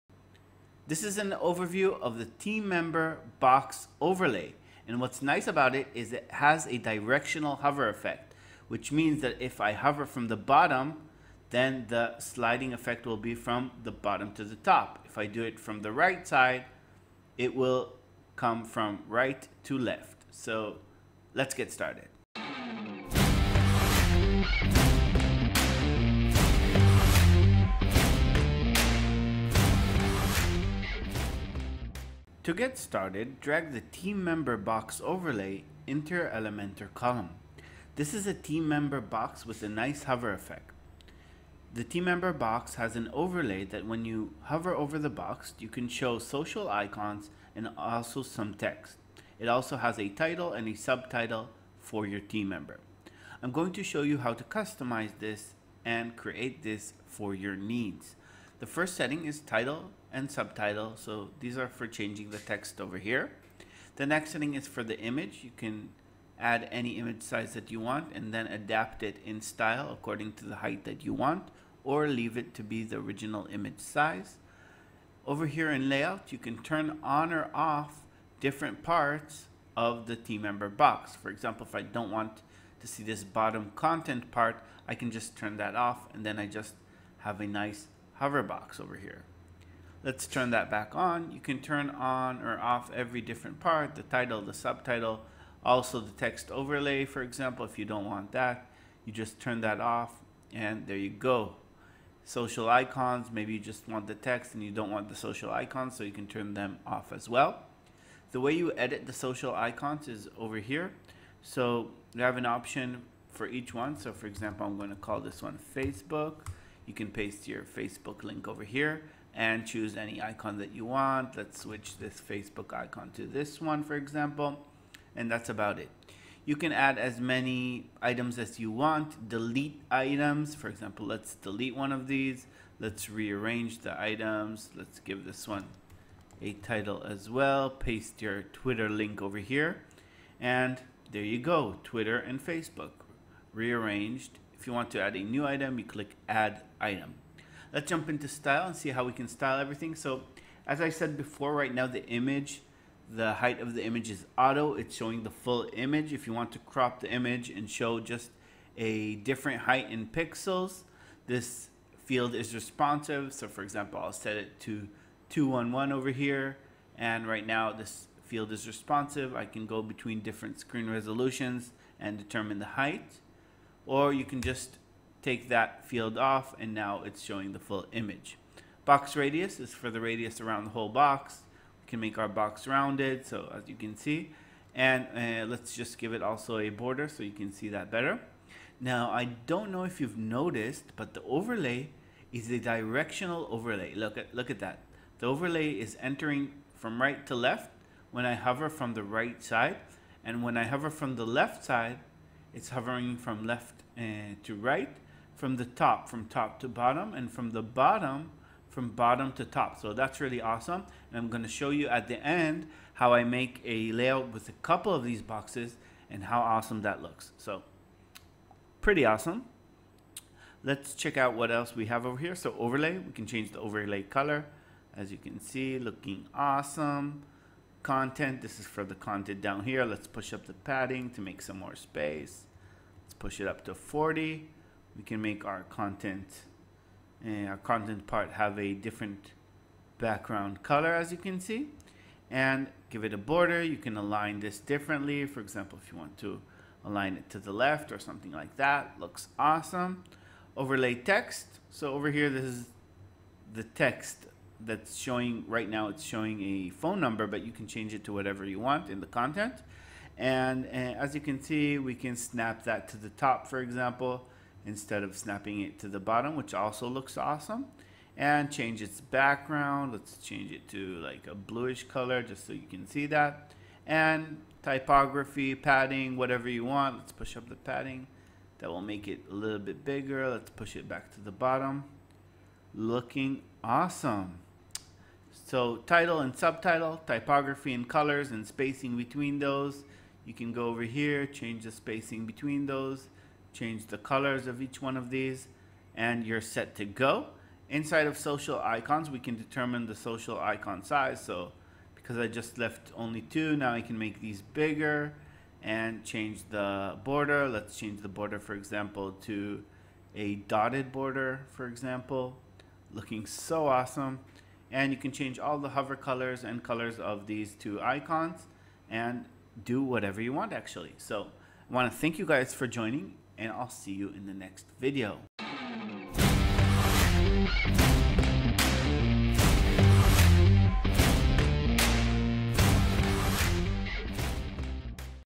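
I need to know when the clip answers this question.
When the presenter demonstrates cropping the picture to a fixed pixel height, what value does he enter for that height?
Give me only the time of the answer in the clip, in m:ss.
2:45.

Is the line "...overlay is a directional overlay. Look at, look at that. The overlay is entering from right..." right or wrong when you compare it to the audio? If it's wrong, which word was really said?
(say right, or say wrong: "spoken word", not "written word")
right.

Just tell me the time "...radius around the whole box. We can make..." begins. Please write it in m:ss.
3:00.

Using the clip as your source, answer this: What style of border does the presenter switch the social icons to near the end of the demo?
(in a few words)
Dotted.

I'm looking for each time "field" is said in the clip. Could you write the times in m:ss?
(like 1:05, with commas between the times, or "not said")
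2:42, 2:48, 2:55.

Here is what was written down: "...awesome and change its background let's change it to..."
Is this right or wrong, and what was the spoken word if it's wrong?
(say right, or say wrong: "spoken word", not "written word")
right.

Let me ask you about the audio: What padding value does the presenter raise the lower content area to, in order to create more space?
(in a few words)
40.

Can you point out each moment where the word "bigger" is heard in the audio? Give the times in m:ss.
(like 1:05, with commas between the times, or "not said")
4:39, 5:04.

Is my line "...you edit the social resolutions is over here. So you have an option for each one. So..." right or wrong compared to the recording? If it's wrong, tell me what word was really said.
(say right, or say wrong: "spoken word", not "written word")
wrong: "icons", not "resolutions".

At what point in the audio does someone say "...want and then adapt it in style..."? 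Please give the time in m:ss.
1:07.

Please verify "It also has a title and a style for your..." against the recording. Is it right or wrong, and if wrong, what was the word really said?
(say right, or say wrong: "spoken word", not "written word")
wrong: "subtitle", not "style".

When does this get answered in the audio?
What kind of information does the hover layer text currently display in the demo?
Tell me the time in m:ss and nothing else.
4:16.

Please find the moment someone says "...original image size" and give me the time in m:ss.
1:12.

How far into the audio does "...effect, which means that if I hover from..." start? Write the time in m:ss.
0:07.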